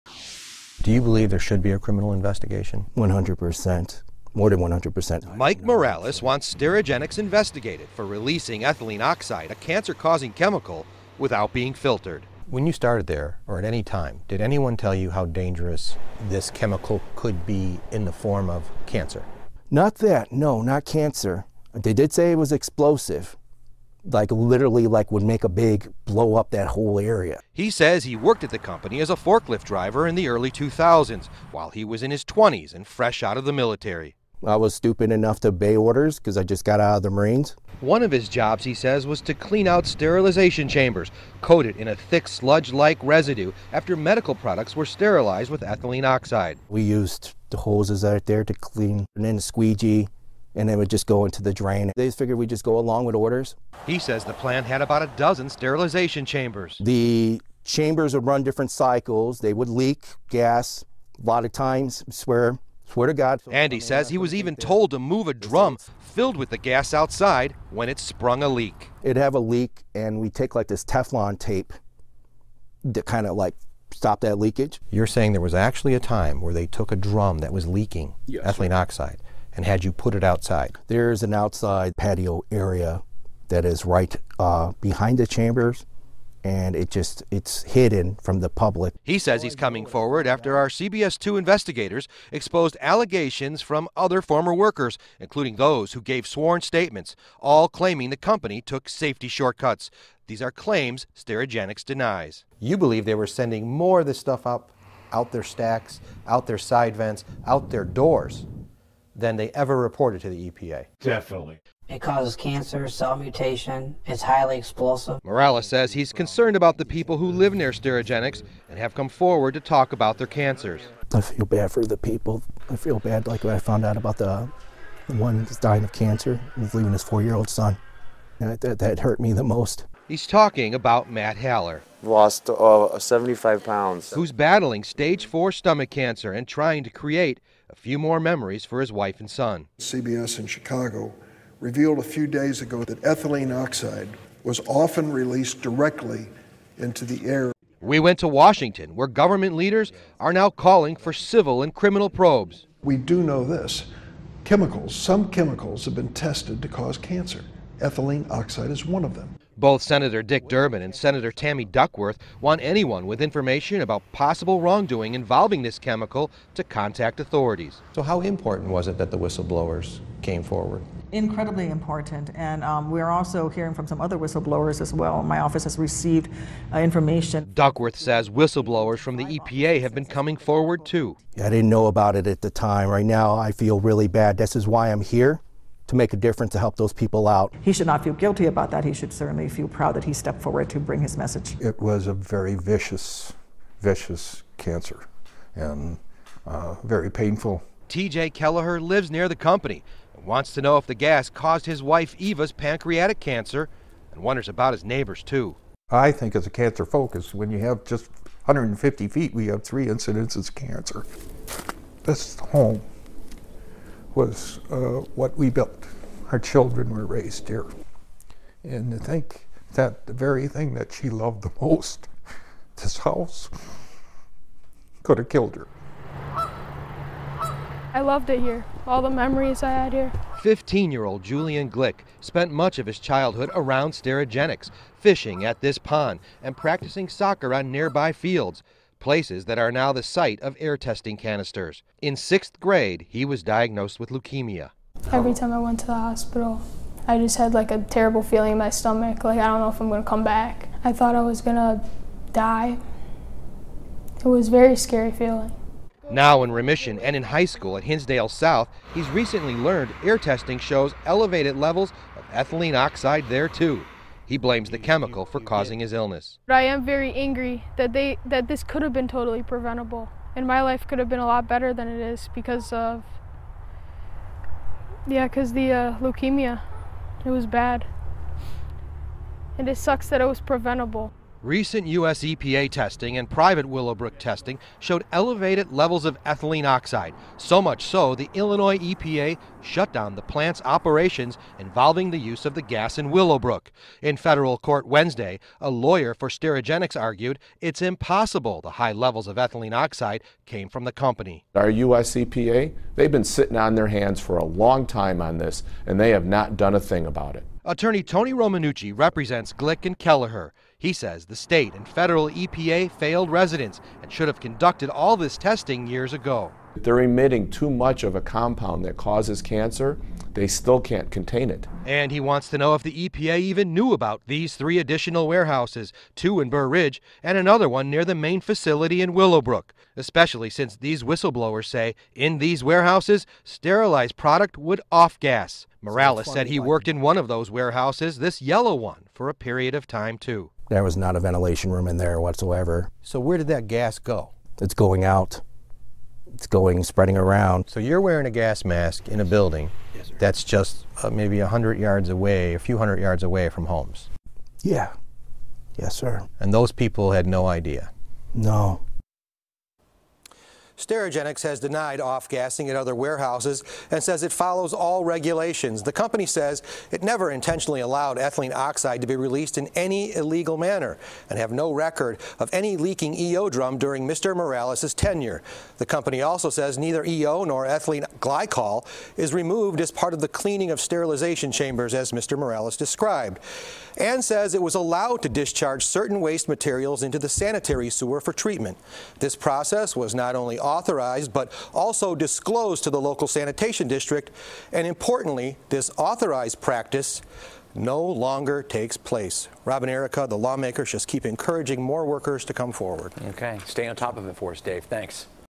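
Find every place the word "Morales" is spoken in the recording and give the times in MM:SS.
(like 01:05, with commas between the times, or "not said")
00:05, 01:55, 05:35, 06:14, 06:22.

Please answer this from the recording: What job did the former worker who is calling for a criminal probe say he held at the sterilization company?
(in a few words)
Forklift driver.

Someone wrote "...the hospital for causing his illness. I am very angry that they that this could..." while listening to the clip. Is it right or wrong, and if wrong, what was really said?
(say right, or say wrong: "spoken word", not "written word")
wrong: "chemical", not "hospital".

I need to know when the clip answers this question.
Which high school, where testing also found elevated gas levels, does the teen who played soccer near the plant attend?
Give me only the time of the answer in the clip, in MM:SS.
04:17.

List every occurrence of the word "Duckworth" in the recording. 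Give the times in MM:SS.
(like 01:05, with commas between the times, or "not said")
02:41, 02:57.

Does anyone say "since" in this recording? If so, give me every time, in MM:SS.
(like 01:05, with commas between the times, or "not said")
05:30.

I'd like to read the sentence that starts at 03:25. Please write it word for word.
I think as a cancer focus, when you have just 150 feet, we have three incidences of cancer.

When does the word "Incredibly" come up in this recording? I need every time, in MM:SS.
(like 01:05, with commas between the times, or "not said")
02:51.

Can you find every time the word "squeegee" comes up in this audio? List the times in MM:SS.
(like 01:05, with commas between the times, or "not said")
00:49.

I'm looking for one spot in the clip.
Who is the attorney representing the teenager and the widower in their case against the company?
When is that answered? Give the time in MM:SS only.
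05:08.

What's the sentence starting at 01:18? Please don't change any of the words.
oxide and had you put it outside.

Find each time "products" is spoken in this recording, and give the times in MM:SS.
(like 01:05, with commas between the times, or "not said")
00:44, 05:34.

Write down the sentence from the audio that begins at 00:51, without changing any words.
They figured we'd just go along with orders.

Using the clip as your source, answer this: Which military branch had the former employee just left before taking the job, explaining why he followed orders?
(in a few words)
Marines.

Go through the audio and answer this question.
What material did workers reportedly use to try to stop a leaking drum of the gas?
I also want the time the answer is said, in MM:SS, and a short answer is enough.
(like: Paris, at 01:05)
Teflon tape, at 01:10.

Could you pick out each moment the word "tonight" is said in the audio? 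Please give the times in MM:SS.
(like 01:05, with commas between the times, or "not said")
not said.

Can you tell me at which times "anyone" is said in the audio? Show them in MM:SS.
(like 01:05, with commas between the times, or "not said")
00:14, 02:42.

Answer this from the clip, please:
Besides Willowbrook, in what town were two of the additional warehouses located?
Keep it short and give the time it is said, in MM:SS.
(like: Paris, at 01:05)
Burr Ridge, at 05:26.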